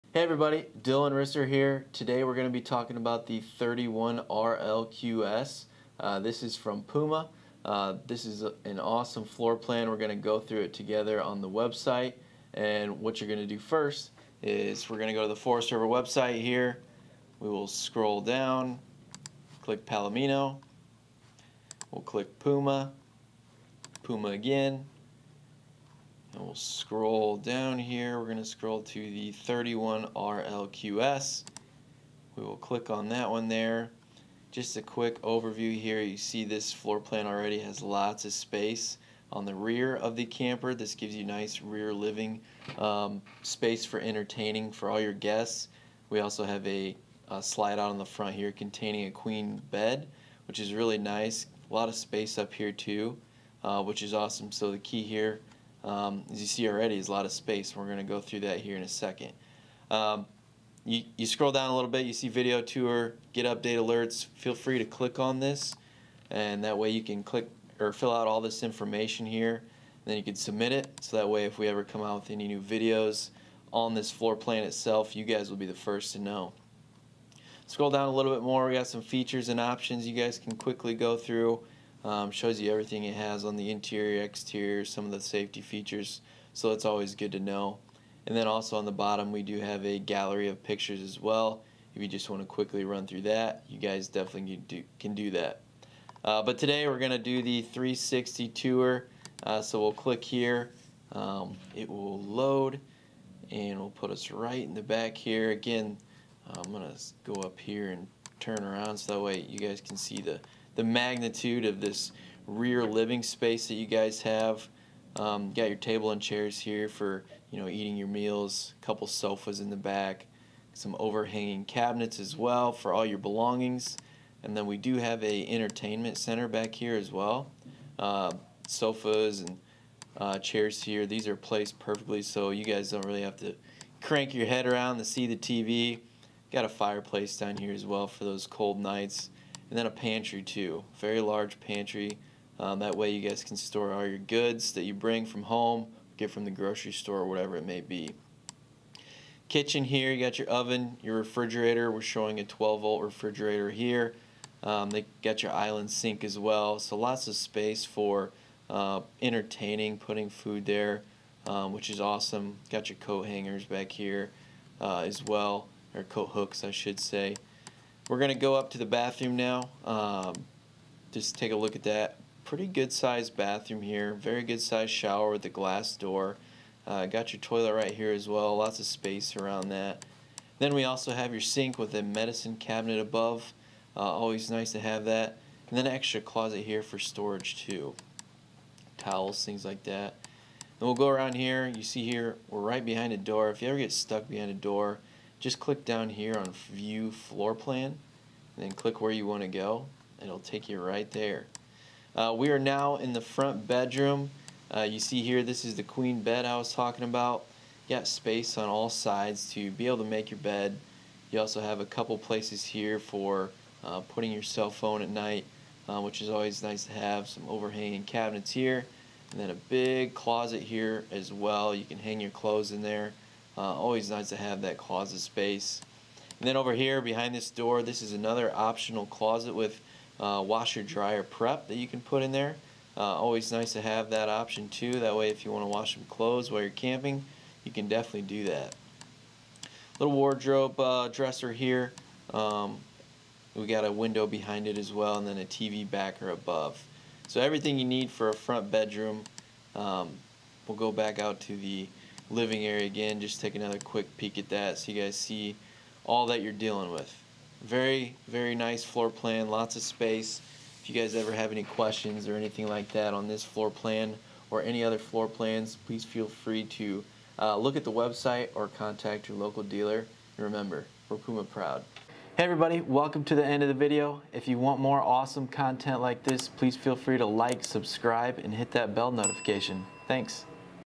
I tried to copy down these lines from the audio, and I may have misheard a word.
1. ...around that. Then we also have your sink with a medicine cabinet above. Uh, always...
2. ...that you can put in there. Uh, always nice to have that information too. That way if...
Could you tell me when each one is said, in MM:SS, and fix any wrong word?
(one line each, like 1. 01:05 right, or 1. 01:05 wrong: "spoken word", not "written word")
1. 02:59 right
2. 03:51 wrong: "option", not "information".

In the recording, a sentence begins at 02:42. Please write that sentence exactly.
Got your coat hangers back here uh, as well, or coat hooks, I should say.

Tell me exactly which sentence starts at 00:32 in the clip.
We will click on that one there.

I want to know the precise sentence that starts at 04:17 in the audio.
Very, very nice floor plan, lots of space.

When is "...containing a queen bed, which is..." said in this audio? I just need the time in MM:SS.
00:48.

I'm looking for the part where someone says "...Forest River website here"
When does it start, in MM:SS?
00:15.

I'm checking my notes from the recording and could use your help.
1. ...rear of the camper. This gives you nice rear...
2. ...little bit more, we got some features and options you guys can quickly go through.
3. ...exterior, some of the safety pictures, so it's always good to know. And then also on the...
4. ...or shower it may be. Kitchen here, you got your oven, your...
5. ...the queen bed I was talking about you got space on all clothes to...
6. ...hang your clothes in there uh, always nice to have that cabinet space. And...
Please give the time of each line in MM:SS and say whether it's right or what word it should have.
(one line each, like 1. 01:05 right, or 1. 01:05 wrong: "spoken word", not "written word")
1. 00:39 right
2. 01:18 right
3. 01:24 wrong: "features", not "pictures"
4. 02:27 wrong: "whatever", not "shower"
5. 03:25 wrong: "sides", not "clothes"
6. 03:41 wrong: "closet", not "cabinet".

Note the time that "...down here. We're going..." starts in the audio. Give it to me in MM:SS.
00:27.